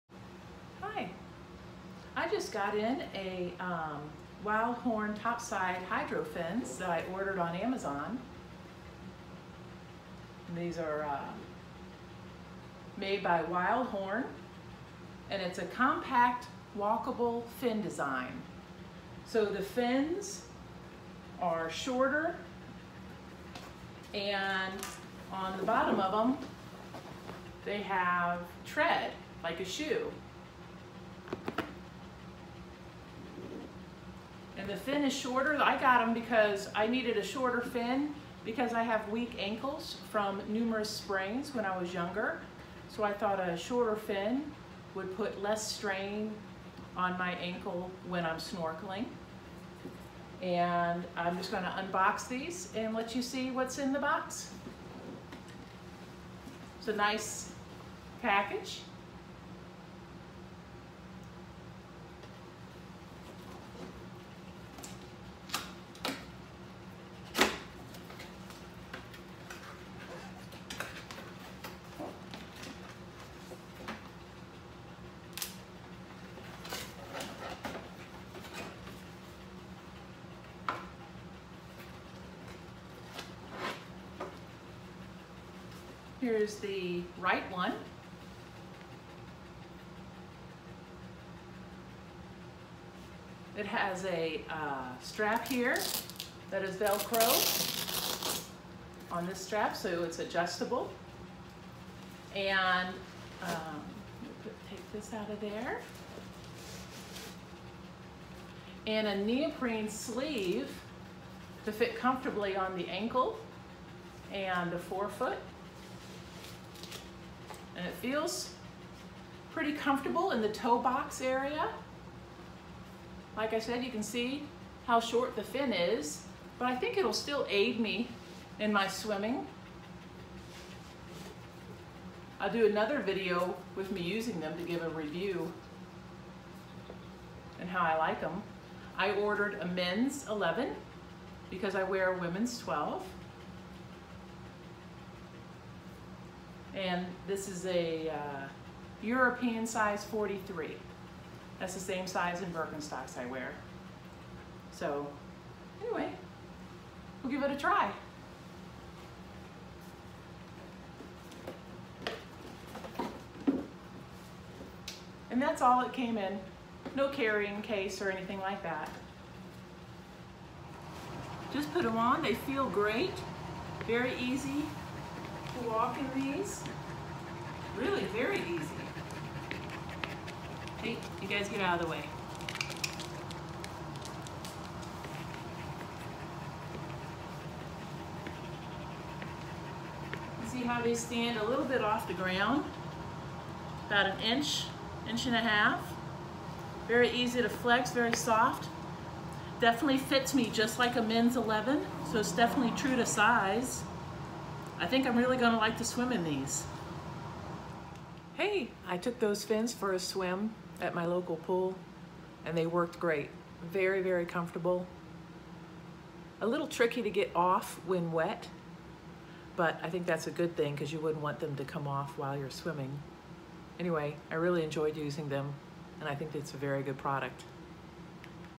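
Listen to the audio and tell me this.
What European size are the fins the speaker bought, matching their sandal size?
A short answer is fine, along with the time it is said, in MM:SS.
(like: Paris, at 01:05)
43, at 02:30.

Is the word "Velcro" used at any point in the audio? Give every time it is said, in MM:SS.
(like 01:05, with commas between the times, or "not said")
01:36.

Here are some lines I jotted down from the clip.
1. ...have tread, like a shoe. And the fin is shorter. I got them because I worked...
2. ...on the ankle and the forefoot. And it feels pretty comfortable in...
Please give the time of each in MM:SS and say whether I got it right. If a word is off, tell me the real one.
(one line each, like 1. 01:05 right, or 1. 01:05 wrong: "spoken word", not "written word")
1. 00:27 wrong: "needed", not "worked"
2. 01:52 right.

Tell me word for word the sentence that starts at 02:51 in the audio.
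Just put them on, they feel great, very easy, Walking walk in these.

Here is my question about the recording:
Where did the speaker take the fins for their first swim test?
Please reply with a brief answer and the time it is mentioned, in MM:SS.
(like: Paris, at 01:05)
local pool, at 03:31.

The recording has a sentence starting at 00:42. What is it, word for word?
So I thought a shorter fin would put less strain on my ankle when I'm snorkeling.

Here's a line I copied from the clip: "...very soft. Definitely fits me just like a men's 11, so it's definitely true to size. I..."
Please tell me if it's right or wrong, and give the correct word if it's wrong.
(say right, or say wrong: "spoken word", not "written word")
right.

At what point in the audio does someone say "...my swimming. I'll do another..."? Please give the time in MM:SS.
02:08.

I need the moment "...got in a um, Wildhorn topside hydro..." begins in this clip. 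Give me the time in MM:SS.
00:02.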